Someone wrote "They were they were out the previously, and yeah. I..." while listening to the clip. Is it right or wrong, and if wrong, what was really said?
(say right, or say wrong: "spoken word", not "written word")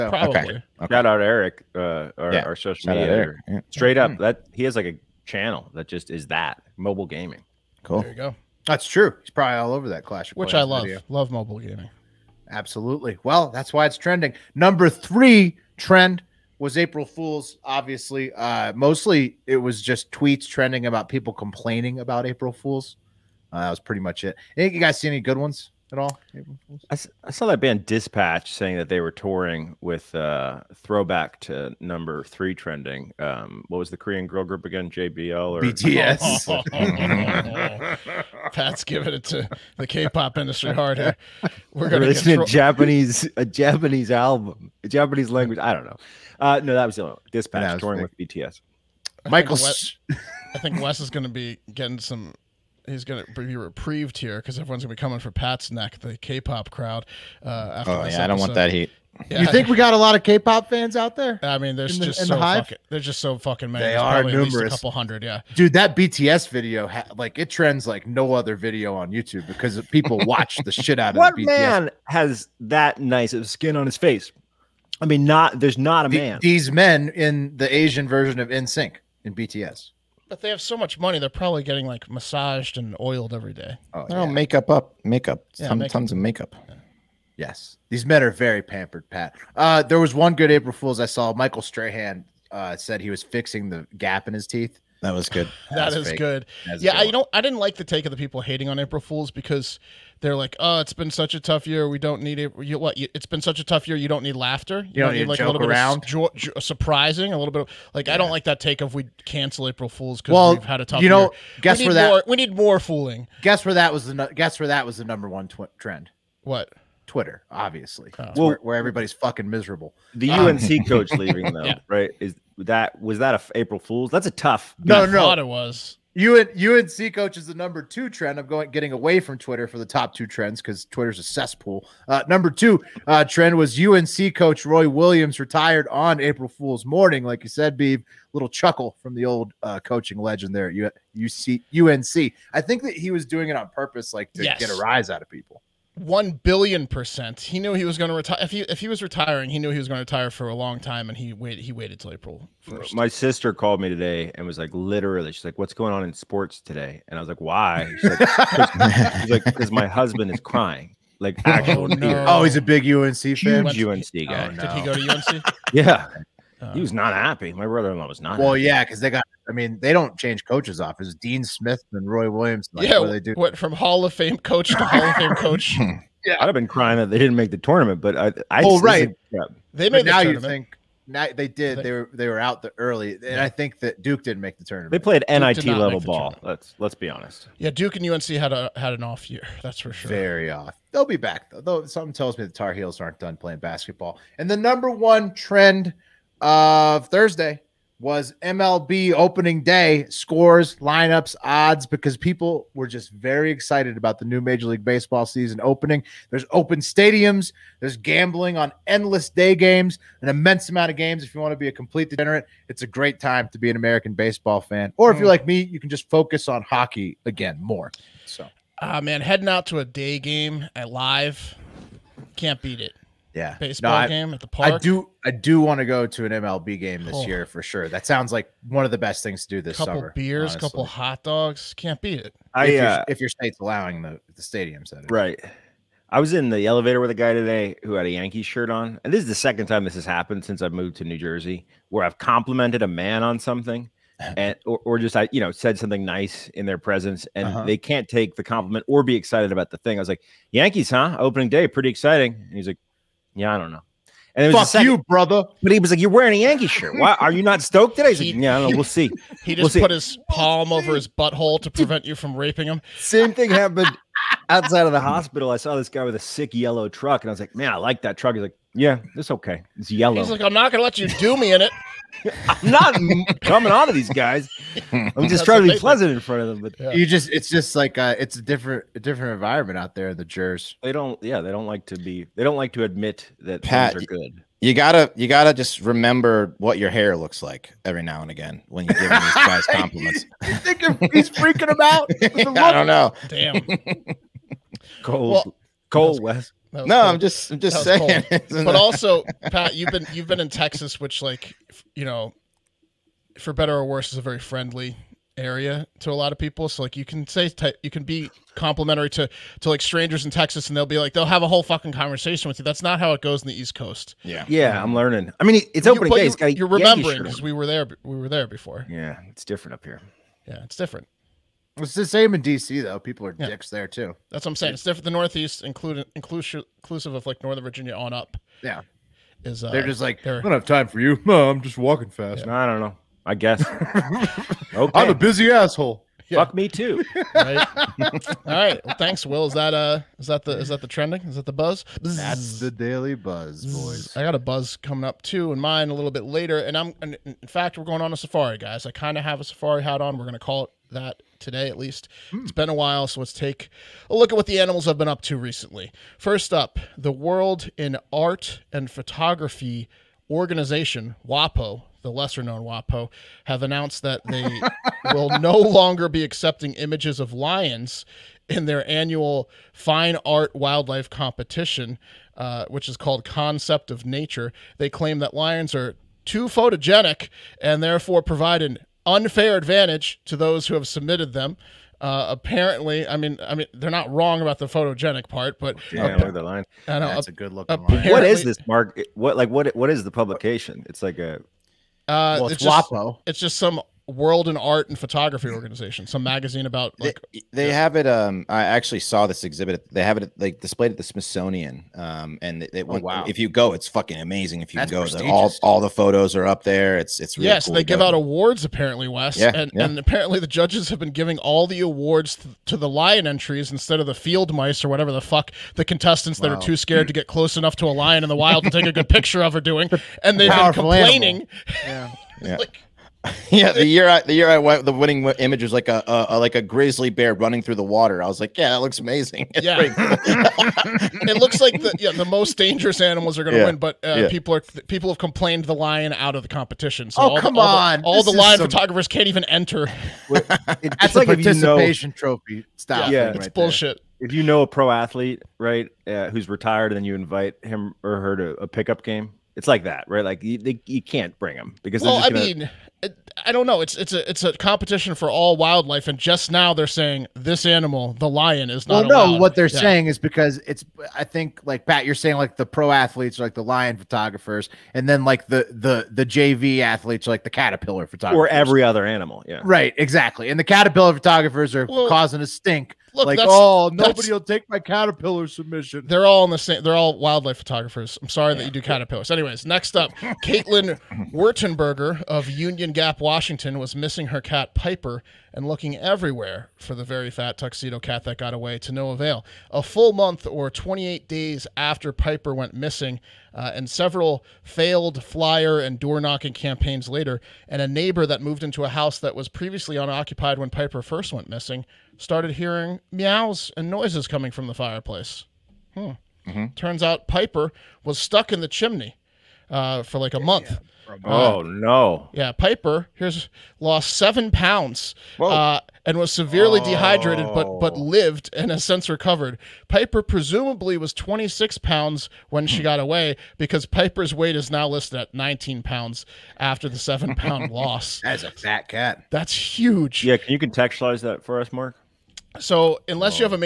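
wrong: "early", not "previously".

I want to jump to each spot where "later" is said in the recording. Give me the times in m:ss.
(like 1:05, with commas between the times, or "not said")
5:46, 8:17.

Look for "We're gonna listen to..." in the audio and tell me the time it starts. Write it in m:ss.
0:41.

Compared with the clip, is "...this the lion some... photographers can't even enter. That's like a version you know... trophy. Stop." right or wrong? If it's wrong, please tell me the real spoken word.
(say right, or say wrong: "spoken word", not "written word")
wrong: "participation", not "version".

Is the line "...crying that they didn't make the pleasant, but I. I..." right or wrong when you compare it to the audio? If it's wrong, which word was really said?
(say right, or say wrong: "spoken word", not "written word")
wrong: "tournament", not "pleasant".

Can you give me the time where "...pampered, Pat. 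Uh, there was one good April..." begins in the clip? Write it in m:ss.
1:28.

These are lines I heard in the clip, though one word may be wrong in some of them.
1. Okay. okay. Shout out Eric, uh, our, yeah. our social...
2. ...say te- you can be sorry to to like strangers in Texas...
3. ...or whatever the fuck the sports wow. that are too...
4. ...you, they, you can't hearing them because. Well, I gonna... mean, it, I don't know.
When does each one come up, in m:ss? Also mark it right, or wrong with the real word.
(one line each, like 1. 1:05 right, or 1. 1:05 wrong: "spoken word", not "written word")
1. 0:00 right
2. 5:07 wrong: "complimentary", not "sorry"
3. 6:54 wrong: "contestants", not "sports"
4. 7:30 wrong: "bring", not "hearing".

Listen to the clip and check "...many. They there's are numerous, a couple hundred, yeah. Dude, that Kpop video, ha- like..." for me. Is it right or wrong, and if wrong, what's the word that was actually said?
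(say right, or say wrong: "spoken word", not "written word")
wrong: "BTS", not "Kpop".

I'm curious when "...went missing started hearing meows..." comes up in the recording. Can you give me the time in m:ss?
8:21.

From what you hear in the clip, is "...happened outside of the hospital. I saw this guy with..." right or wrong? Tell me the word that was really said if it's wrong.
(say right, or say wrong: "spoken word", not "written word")
right.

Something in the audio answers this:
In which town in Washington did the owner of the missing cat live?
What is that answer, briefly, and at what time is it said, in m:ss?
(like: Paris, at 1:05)
Union Gap, at 8:02.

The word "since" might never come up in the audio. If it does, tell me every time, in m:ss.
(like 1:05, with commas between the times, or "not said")
4:00, 8:38.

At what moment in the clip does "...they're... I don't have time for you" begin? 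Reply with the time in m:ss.
5:30.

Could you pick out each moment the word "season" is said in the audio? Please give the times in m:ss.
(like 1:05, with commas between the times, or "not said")
3:25.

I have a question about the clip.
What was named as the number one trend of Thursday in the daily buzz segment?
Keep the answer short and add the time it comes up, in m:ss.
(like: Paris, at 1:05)
MLB opening day, at 3:18.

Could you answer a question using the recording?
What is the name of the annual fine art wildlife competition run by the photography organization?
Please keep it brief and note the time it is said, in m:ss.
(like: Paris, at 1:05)
Concept of Nature, at 6:13.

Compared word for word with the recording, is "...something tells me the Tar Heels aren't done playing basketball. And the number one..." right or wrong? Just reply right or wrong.
right.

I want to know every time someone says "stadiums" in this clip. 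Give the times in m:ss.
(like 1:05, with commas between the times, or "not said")
3:26, 3:54.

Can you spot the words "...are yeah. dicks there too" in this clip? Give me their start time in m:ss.
5:23.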